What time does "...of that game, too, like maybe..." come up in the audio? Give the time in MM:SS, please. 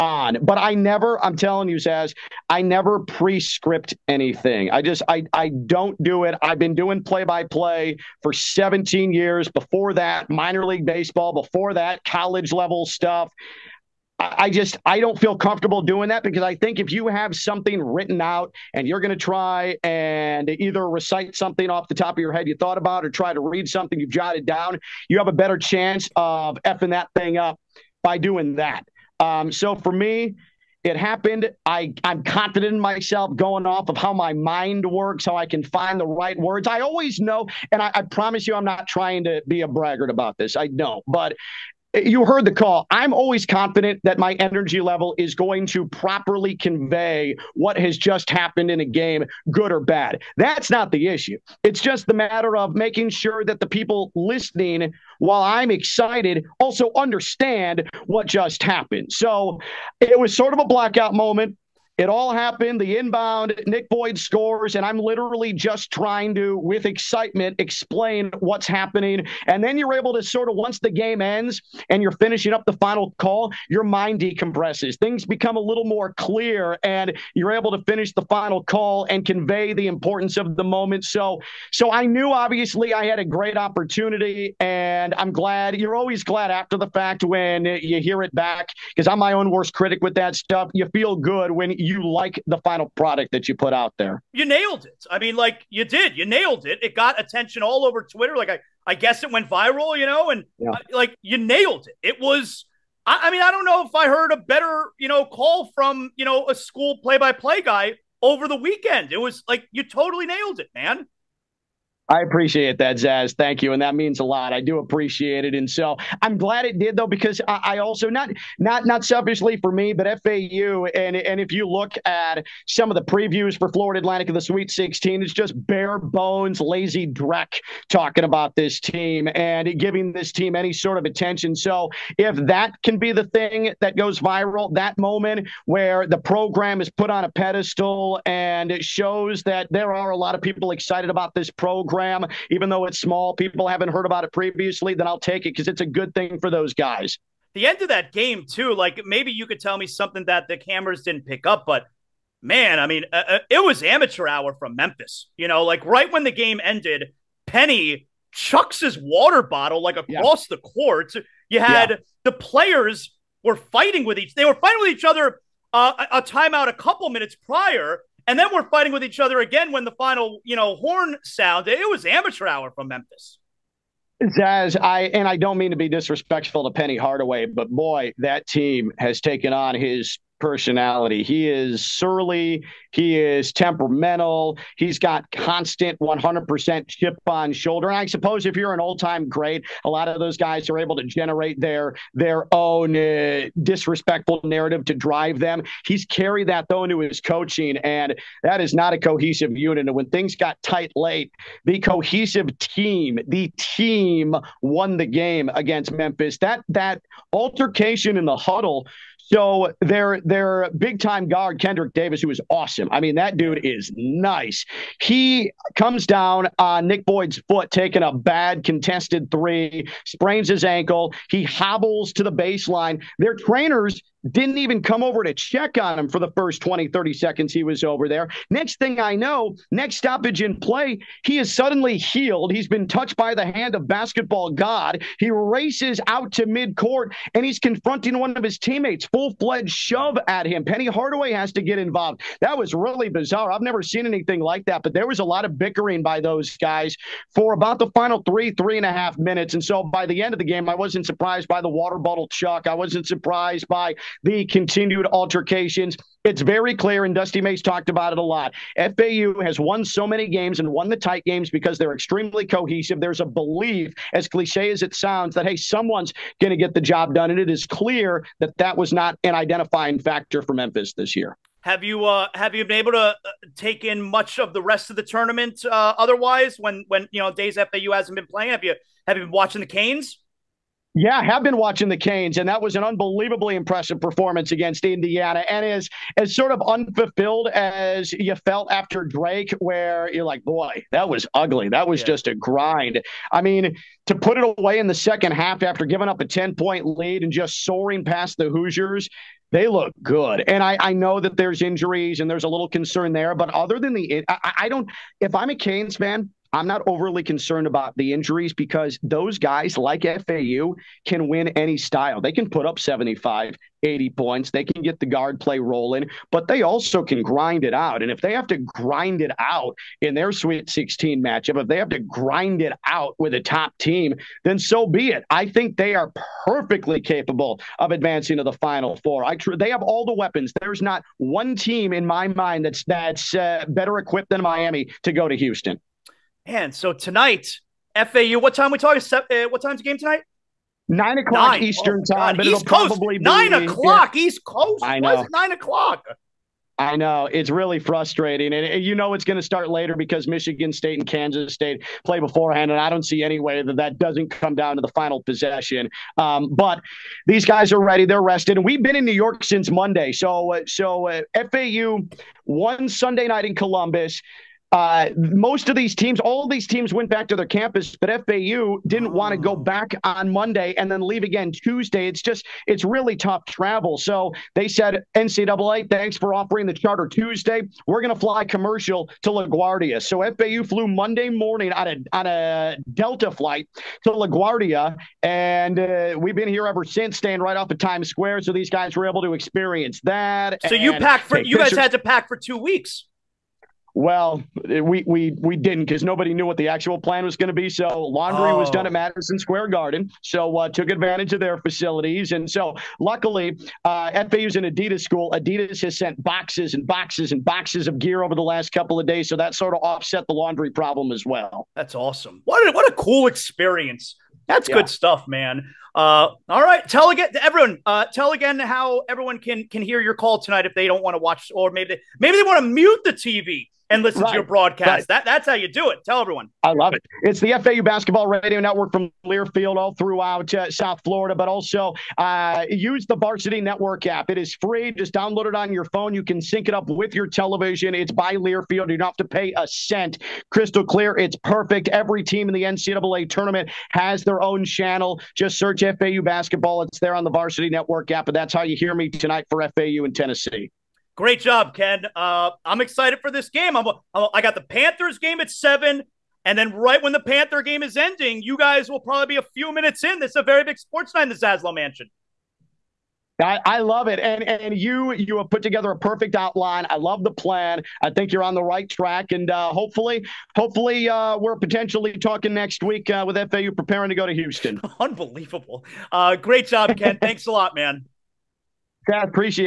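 02:27.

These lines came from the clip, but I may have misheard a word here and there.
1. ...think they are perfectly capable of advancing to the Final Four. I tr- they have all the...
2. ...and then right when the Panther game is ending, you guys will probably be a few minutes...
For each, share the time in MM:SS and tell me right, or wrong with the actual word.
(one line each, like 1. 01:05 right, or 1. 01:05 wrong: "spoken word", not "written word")
1. 05:25 right
2. 07:36 right.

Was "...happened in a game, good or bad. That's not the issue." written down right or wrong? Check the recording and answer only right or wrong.
right.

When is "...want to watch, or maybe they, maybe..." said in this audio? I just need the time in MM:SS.
07:01.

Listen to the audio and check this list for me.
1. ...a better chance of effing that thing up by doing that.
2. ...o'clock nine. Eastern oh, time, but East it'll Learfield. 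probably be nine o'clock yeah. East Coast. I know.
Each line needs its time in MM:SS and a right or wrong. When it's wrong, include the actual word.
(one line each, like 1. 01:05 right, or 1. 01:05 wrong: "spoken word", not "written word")
1. 00:25 right
2. 05:41 wrong: "Coast", not "Learfield".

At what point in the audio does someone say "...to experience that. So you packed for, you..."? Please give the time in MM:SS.
06:29.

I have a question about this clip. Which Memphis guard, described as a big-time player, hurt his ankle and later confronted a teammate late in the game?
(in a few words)
Kendrick Davis.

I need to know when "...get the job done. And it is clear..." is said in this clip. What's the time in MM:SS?
04:26.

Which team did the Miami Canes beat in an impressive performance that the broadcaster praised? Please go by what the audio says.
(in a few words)
Indiana.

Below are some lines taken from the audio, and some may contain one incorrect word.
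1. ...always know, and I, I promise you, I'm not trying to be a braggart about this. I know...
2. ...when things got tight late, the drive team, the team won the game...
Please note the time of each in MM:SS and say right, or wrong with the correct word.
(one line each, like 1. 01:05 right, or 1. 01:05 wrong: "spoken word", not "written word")
1. 00:36 right
2. 03:19 wrong: "cohesive", not "drive".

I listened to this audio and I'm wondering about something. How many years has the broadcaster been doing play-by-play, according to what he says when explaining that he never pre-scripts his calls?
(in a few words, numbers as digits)
17.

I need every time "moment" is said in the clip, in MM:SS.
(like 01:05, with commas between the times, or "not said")
01:01, 01:20, 02:14.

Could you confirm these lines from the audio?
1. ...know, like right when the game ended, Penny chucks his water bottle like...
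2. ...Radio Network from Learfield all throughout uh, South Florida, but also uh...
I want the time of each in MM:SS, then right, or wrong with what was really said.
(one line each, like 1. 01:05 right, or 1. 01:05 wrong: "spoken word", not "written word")
1. 02:35 right
2. 07:08 right.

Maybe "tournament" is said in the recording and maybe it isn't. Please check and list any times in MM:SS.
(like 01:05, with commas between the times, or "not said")
04:35, 07:23.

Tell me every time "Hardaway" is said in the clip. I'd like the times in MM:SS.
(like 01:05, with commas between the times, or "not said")
02:56, 04:00.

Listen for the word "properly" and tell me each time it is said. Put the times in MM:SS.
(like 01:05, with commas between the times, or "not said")
00:45.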